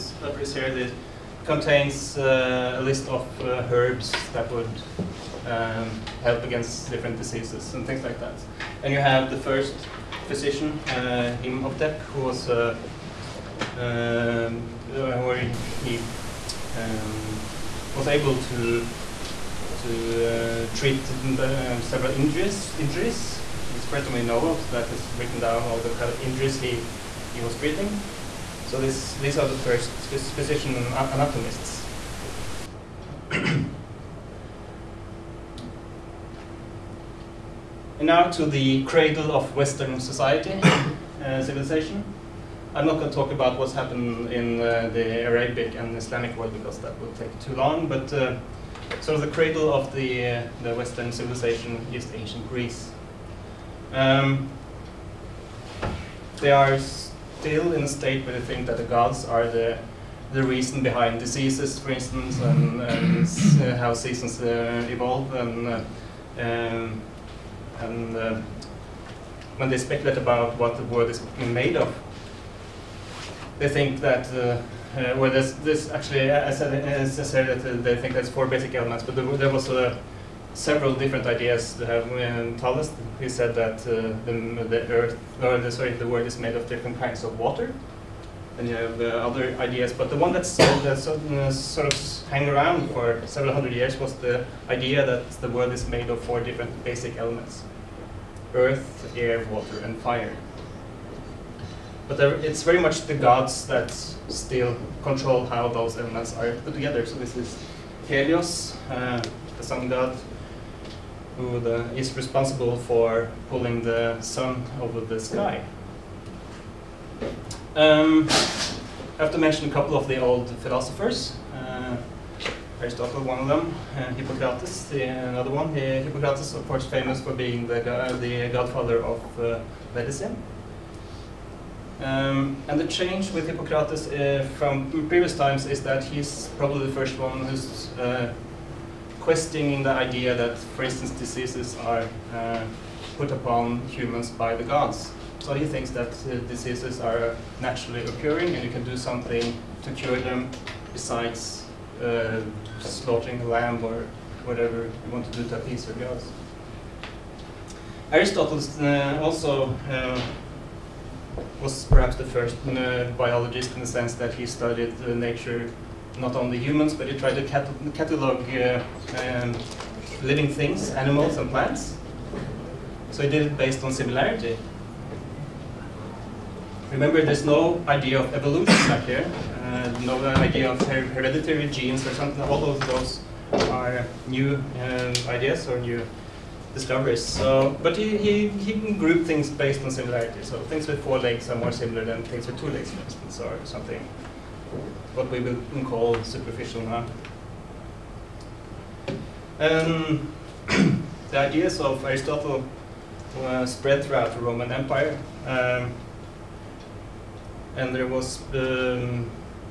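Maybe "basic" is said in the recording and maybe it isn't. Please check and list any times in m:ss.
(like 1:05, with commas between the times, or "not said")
1:18, 1:36.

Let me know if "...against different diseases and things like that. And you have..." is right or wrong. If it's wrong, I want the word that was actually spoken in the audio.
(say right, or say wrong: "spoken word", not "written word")
right.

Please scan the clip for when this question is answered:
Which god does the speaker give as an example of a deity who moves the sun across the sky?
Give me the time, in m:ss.
1:48.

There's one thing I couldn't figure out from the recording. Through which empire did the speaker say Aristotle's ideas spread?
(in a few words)
The Roman Empire.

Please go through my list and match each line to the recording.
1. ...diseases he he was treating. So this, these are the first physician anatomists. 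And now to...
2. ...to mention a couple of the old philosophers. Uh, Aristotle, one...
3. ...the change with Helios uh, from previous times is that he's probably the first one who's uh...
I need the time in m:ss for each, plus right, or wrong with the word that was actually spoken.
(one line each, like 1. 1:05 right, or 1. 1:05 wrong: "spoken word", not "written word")
1. 0:26 wrong: "injuries", not "diseases"
2. 1:59 right
3. 2:12 wrong: "Hippocrates", not "Helios".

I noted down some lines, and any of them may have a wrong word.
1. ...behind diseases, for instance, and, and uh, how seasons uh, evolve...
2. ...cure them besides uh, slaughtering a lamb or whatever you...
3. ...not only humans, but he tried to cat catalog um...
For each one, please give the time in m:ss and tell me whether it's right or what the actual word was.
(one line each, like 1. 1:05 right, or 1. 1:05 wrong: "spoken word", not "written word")
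1. 1:00 right
2. 2:29 right
3. 2:46 right.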